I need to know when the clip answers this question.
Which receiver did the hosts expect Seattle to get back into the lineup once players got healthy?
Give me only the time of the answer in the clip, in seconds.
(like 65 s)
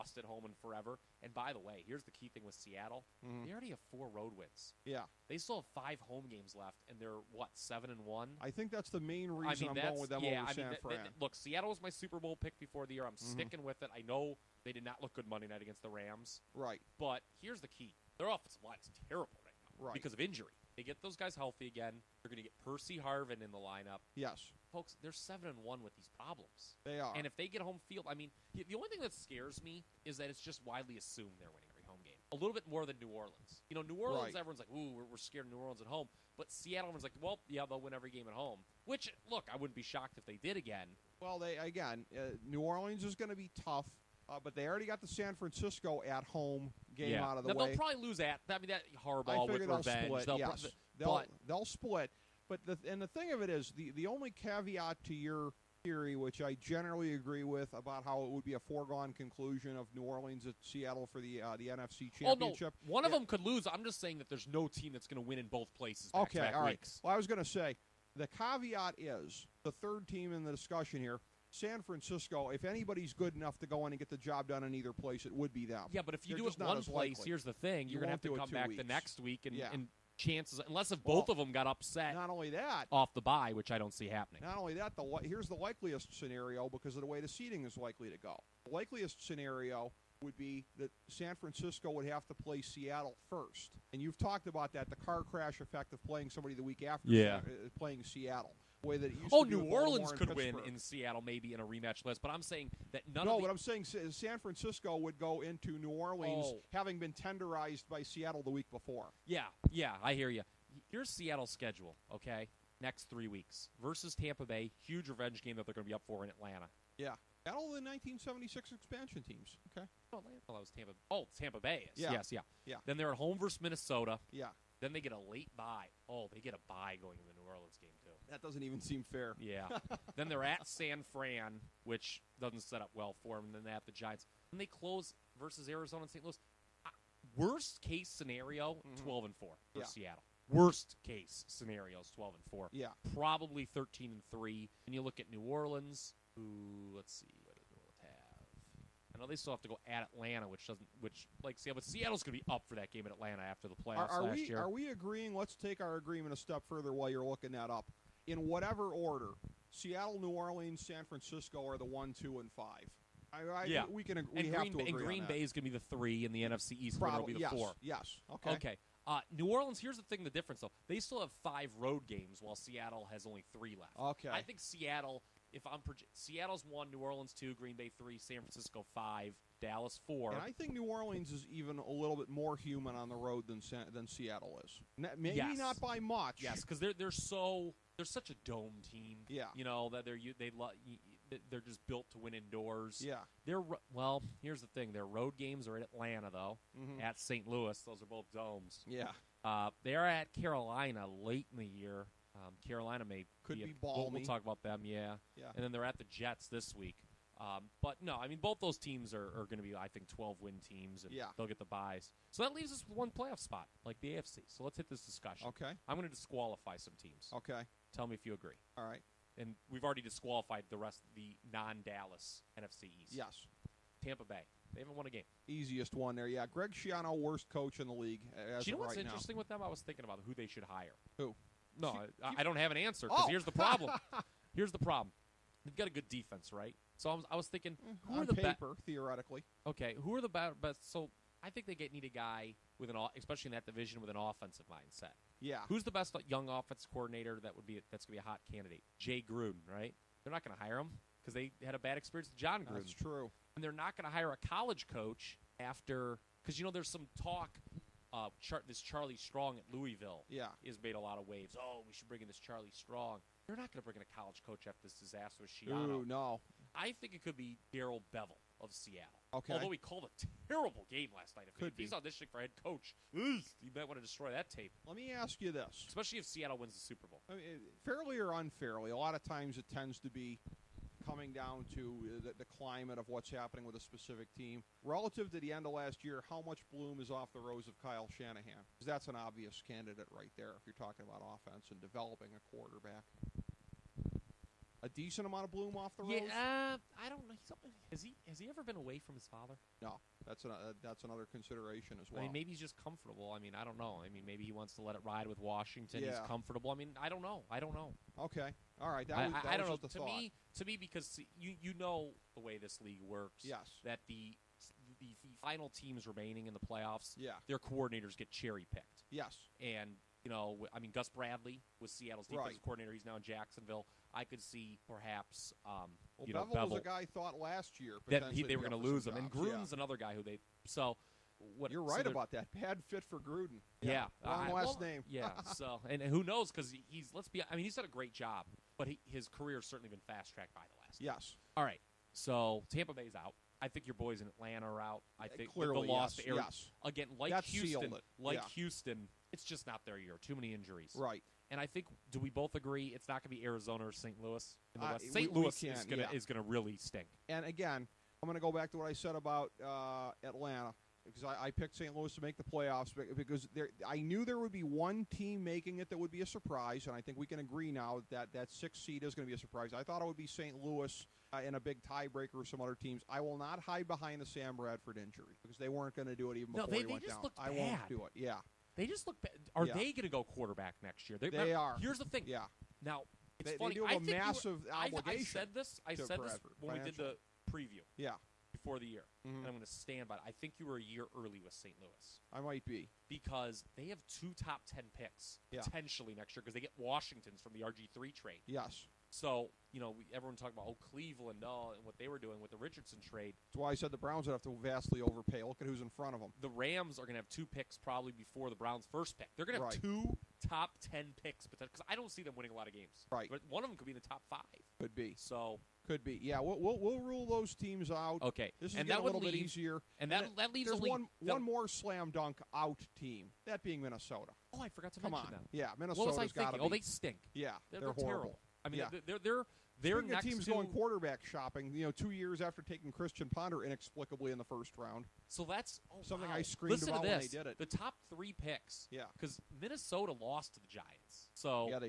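22 s.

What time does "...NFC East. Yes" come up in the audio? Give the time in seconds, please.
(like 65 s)
222 s.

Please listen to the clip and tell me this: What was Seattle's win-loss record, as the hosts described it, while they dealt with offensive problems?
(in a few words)
7 and 1.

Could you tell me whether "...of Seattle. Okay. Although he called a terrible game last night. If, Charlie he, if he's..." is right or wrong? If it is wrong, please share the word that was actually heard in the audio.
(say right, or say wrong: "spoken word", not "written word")
wrong: "Could", not "Charlie".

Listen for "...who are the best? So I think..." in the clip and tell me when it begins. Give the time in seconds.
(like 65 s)
240 s.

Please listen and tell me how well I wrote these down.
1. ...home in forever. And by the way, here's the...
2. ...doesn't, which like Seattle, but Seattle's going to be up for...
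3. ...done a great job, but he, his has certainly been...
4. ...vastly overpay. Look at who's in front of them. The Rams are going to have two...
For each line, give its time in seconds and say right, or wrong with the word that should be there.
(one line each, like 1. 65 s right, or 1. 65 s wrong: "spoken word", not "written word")
1. 0 s right
2. 150 s right
3. 337 s right
4. 404 s right.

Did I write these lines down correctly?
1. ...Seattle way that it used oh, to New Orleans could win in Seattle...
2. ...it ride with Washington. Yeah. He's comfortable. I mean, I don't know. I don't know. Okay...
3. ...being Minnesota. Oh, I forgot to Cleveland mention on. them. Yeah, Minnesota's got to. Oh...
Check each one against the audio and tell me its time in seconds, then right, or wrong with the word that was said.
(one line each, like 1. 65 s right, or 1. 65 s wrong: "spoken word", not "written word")
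1. 98 s right
2. 304 s right
3. 423 s wrong: "Come", not "Cleveland".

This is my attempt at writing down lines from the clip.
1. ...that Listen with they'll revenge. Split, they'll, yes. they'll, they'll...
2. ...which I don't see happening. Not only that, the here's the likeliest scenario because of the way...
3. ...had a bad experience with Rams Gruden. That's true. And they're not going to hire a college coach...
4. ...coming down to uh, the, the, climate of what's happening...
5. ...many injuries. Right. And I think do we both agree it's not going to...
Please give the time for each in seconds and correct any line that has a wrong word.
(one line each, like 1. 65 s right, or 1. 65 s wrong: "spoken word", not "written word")
1. 48 s wrong: "Harbaugh", not "Listen"
2. 83 s right
3. 251 s wrong: "Jon", not "Rams"
4. 281 s right
5. 350 s right.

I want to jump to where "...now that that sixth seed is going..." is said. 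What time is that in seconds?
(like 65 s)
367 s.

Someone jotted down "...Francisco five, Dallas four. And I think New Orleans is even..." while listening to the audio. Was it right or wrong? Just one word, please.
right.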